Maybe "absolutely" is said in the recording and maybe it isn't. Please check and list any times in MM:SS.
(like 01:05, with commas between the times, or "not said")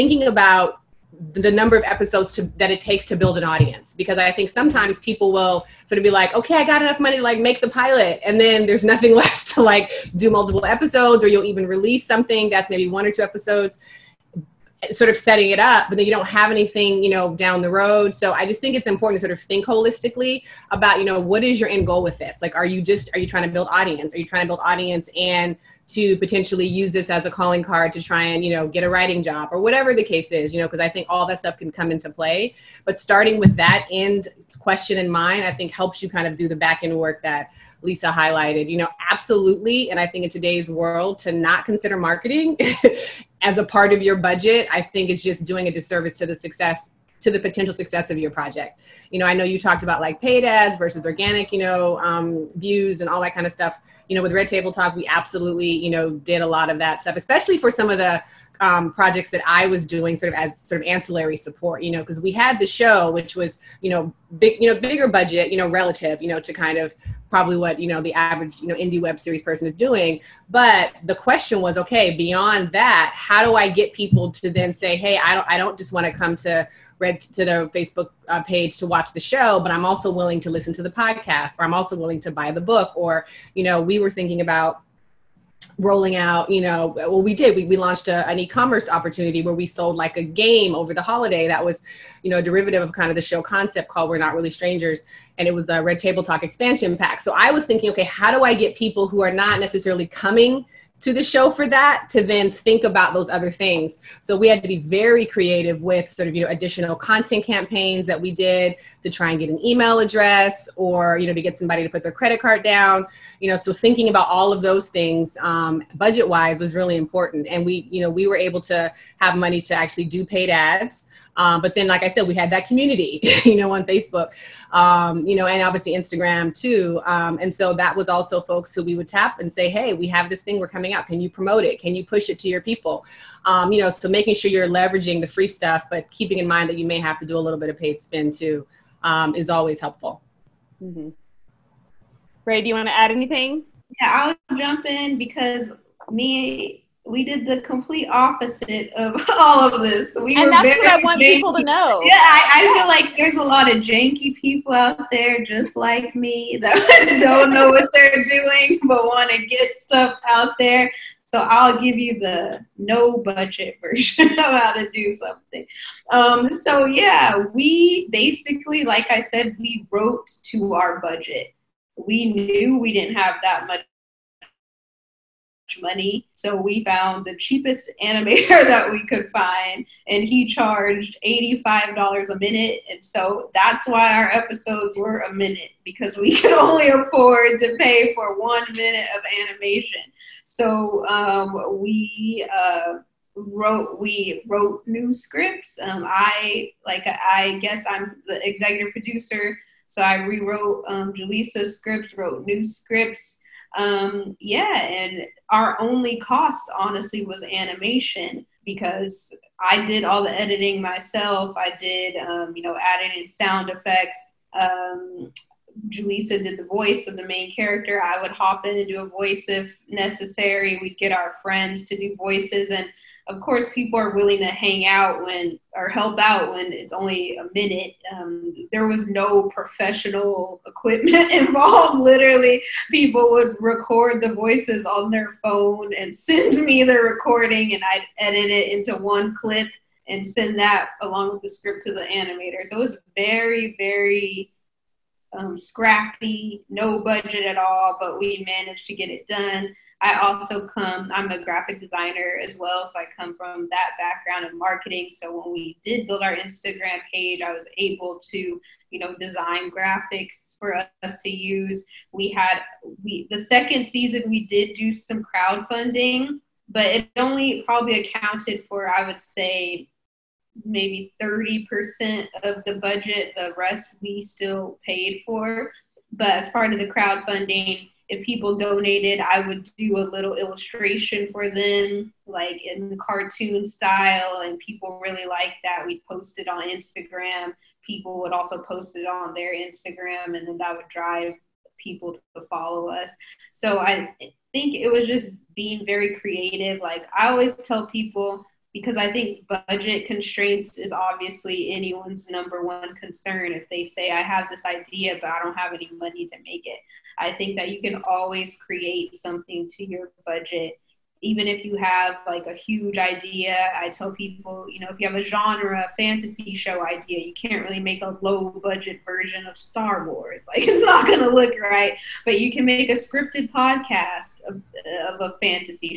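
00:39, 00:55.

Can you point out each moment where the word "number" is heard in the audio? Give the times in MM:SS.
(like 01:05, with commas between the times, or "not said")
00:01, 05:02.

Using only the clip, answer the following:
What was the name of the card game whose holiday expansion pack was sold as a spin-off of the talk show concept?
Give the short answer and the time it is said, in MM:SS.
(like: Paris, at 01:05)
We're Not Really Strangers, at 01:34.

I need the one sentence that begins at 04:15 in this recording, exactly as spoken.
So when we did build our Instagram page, I was able to, you know, design graphics for us to use.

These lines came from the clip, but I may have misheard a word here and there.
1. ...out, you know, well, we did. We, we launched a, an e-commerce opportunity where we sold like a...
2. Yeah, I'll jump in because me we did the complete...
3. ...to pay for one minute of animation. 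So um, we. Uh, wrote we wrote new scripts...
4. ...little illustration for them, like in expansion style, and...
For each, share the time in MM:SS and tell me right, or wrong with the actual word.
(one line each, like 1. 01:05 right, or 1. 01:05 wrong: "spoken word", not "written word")
1. 01:26 right
2. 02:23 right
3. 03:07 right
4. 04:40 wrong: "cartoon", not "expansion".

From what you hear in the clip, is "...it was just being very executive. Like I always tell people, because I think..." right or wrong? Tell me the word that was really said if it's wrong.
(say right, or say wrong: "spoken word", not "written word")
wrong: "creative", not "executive".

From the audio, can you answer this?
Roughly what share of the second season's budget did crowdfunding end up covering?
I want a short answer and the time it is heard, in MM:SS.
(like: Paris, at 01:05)
30%, at 04:31.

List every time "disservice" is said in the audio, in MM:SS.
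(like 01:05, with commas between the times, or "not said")
00:45.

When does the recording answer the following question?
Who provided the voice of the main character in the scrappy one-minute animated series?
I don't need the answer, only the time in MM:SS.
03:35.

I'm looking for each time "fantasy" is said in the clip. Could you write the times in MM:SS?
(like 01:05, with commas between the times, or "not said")
05:15, 05:25.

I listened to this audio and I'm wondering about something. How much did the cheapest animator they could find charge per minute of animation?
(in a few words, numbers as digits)
$85.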